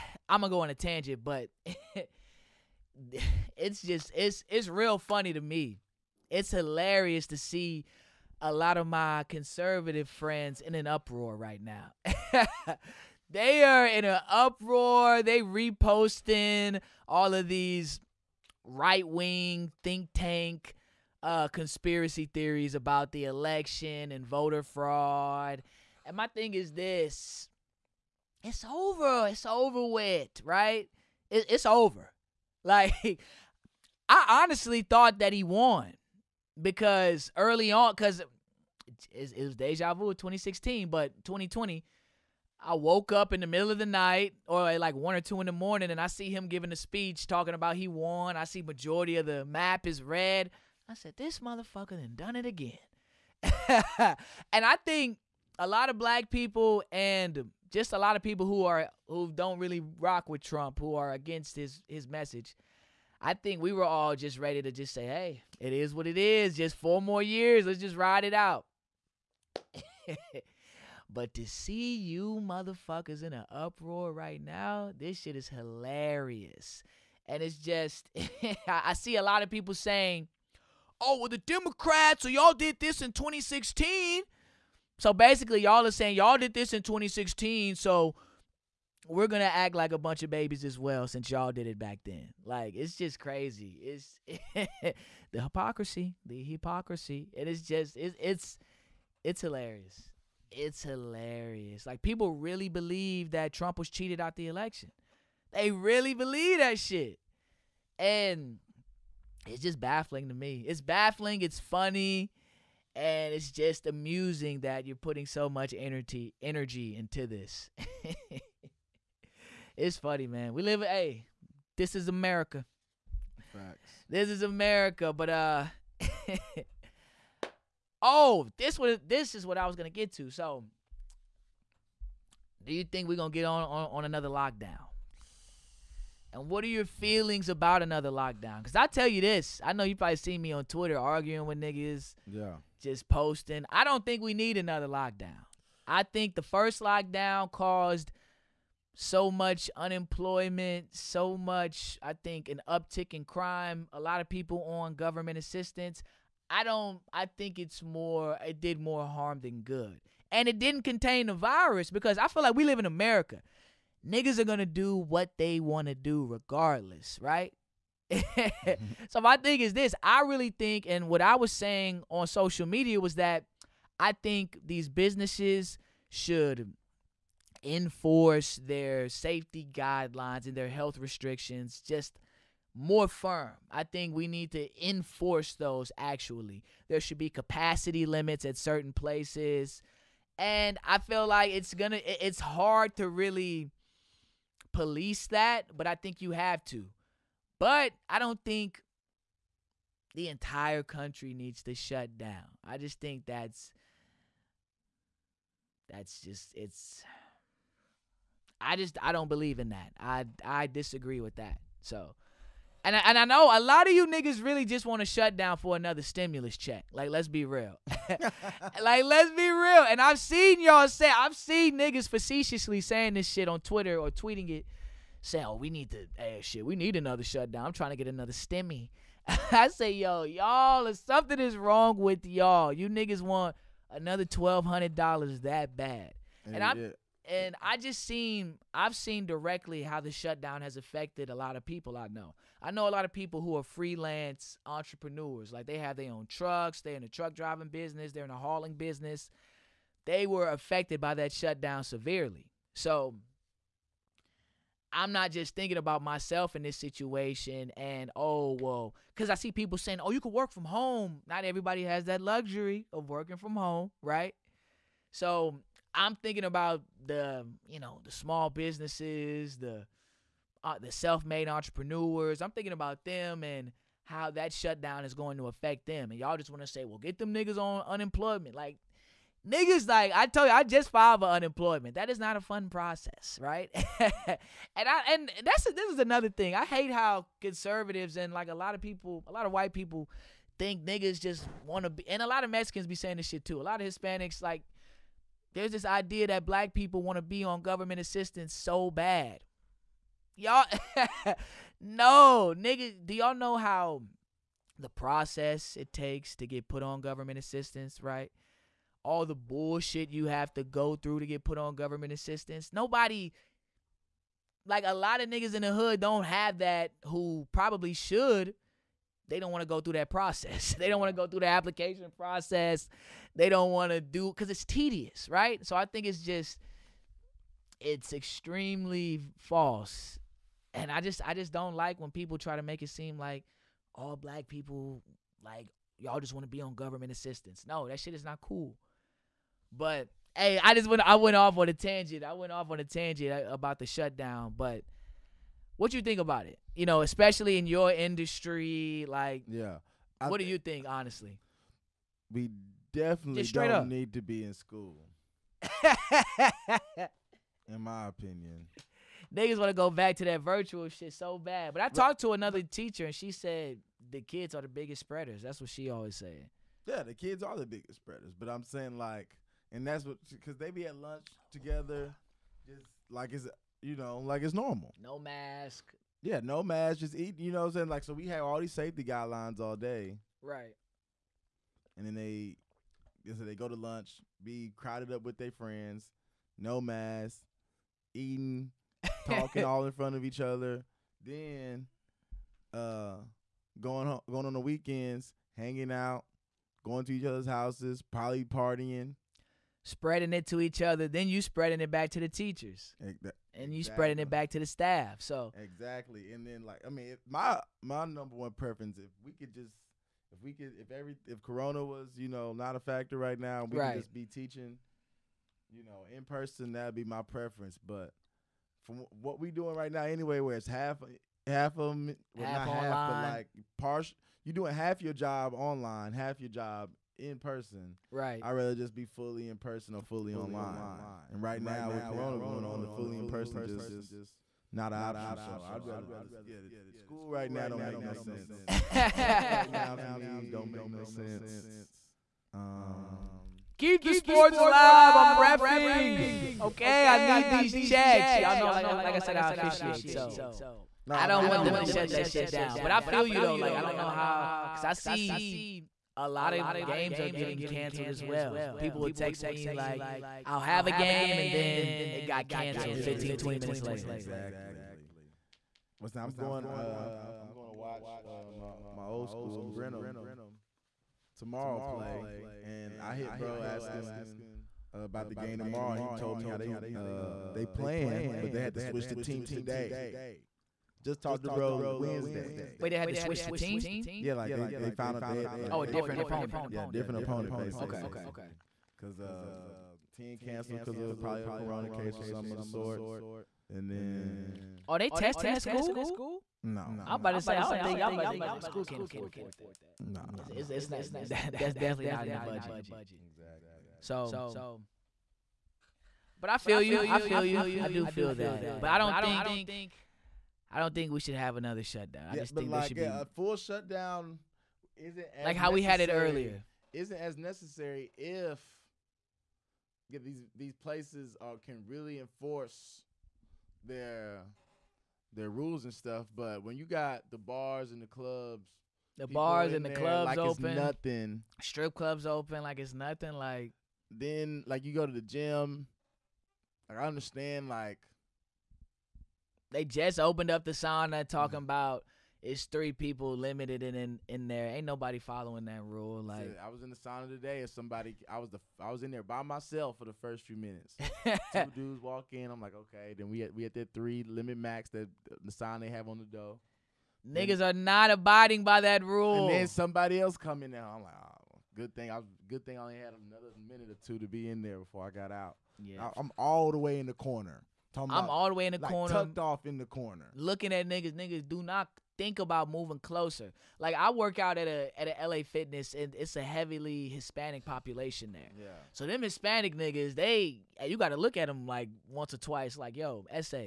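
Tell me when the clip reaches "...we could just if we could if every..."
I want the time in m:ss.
6:49.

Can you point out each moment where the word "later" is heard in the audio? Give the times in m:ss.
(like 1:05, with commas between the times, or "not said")
7:43.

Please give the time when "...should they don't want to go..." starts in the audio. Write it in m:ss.
5:17.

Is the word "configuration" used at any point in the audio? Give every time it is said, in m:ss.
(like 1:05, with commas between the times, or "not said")
not said.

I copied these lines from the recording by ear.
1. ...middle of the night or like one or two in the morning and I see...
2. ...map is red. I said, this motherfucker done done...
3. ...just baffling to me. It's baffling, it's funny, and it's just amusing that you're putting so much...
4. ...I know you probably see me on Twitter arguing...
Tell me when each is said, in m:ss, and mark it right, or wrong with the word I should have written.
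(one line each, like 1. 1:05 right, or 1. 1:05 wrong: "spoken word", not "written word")
1. 0:43 right
2. 0:49 right
3. 1:49 right
4. 2:19 right.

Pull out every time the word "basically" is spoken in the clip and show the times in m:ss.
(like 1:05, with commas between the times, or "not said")
1:25, 8:07.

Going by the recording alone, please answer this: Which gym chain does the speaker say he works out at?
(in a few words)
LA Fitness.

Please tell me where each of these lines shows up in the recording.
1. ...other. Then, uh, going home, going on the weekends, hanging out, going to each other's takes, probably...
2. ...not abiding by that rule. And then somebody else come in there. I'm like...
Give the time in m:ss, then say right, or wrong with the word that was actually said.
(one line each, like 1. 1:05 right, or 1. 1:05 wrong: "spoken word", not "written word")
1. 6:30 wrong: "houses", not "takes"
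2. 9:17 right.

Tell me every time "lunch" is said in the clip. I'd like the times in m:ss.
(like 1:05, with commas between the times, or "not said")
6:10, 6:23.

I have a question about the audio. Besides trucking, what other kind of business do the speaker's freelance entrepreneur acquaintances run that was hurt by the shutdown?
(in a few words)
Hauling.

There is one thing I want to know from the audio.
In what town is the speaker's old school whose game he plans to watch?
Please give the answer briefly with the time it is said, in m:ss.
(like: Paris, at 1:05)
Brenham, at 7:49.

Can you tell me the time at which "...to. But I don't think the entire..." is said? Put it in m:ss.
3:16.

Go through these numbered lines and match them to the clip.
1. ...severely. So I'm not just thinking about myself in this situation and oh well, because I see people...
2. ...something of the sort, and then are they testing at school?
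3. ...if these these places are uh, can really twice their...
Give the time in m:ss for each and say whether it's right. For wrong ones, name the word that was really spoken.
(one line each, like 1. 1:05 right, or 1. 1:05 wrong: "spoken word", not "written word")
1. 4:11 right
2. 8:12 right
3. 8:38 wrong: "enforce", not "twice".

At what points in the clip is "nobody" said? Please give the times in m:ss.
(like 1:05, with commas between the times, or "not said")
5:12, 9:04.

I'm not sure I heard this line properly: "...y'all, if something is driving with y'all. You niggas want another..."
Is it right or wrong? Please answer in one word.
wrong.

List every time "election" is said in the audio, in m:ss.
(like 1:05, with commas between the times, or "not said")
0:23, 1:44.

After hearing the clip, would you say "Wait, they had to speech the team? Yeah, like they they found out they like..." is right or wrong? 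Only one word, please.
wrong.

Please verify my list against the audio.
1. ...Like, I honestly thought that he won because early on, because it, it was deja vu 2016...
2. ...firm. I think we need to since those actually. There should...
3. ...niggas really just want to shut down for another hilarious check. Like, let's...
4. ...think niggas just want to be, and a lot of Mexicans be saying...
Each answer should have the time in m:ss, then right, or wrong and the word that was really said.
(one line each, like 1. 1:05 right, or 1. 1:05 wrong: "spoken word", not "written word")
1. 0:32 right
2. 3:03 wrong: "enforce", not "since"
3. 3:34 wrong: "stimulus", not "hilarious"
4. 4:50 right.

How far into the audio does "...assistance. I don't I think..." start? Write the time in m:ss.
2:35.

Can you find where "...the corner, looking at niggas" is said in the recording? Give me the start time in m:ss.
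9:29.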